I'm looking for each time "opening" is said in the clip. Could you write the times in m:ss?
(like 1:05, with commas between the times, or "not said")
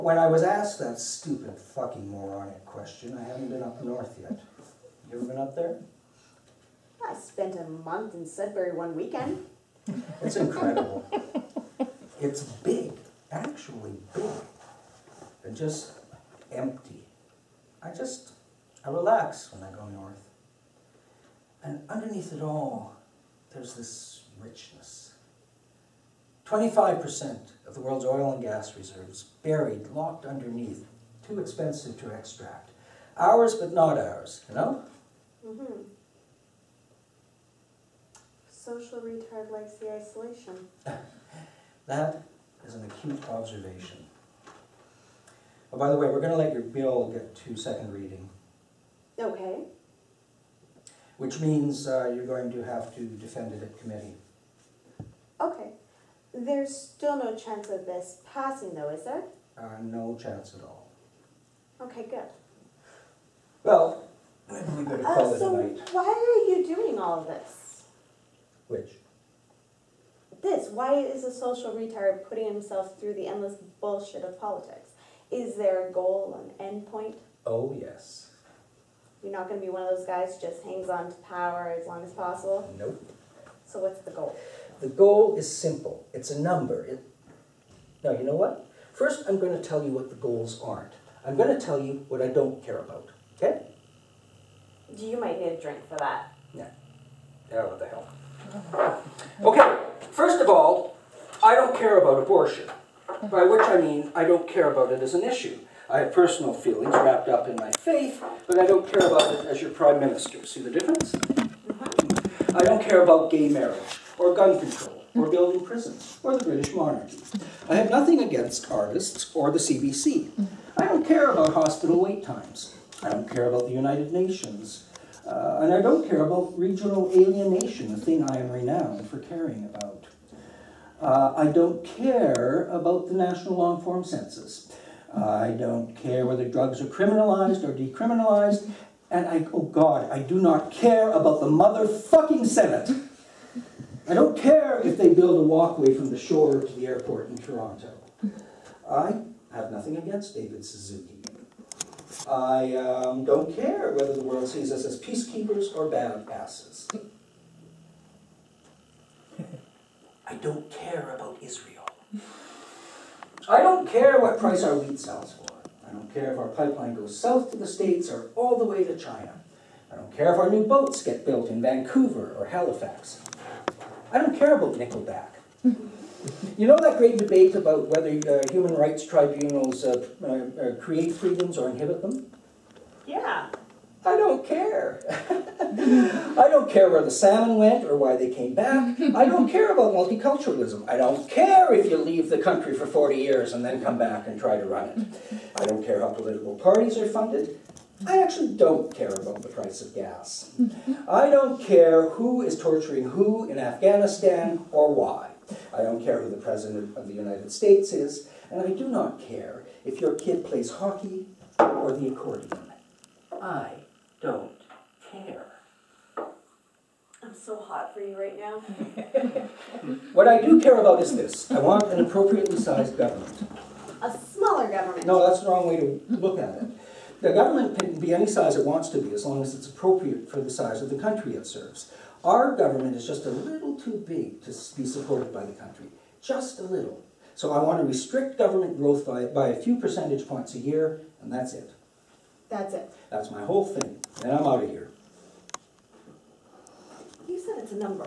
not said.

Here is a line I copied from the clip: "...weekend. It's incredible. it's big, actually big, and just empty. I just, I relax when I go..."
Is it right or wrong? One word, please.
right.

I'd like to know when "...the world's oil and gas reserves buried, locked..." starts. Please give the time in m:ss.
0:27.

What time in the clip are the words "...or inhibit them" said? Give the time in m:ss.
3:01.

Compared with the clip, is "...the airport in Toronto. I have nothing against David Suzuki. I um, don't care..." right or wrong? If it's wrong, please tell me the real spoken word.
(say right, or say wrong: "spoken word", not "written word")
right.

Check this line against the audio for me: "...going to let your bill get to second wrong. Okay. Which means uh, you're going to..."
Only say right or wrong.
wrong.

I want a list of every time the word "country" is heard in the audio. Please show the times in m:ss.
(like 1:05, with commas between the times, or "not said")
3:12, 3:50, 3:55.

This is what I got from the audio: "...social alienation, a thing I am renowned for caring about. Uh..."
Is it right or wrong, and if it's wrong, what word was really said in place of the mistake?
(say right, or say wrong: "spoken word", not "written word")
wrong: "regional", not "social".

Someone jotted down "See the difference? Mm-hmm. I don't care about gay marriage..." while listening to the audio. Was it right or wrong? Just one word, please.
right.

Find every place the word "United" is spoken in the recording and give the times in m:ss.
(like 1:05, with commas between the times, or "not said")
2:03, 3:27.